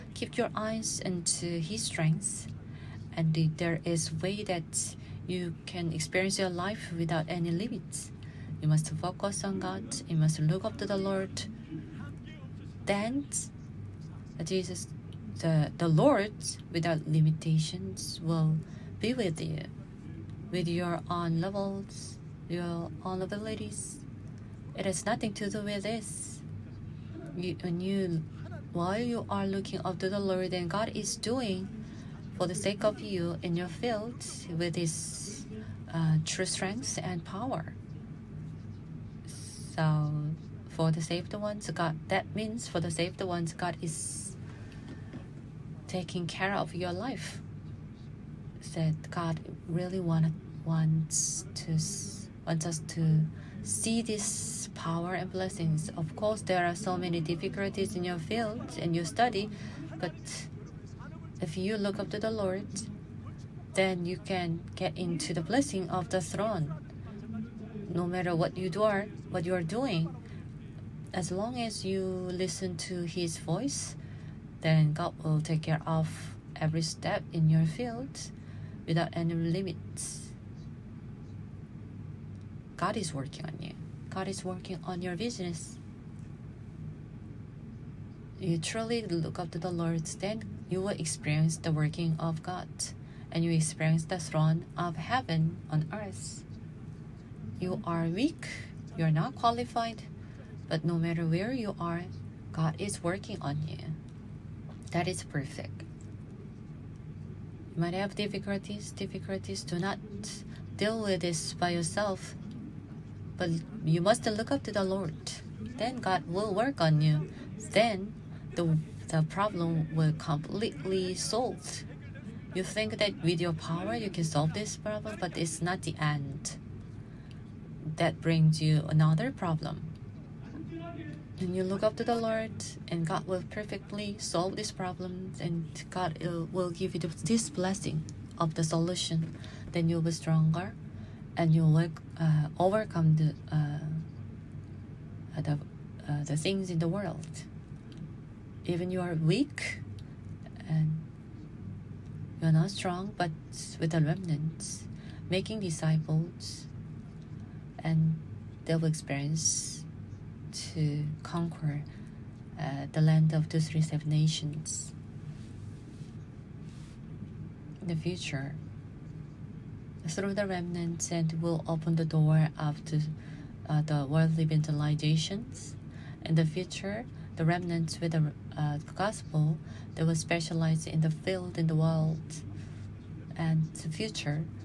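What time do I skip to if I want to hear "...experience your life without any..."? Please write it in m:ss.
0:05.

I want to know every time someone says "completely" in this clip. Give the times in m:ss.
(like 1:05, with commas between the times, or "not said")
2:00.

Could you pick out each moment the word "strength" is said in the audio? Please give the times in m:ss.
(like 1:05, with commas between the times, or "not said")
0:01, 0:36.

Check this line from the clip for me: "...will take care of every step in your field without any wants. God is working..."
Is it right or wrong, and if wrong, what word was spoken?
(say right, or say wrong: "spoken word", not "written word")
wrong: "limits", not "wants".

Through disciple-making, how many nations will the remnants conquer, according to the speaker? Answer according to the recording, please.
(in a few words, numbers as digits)
237.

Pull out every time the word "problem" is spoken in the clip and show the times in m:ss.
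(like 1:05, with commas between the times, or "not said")
1:59, 2:04, 2:09, 2:14.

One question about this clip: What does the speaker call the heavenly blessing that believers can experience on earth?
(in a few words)
the throne of heaven.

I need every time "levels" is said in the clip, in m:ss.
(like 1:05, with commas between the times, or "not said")
0:21.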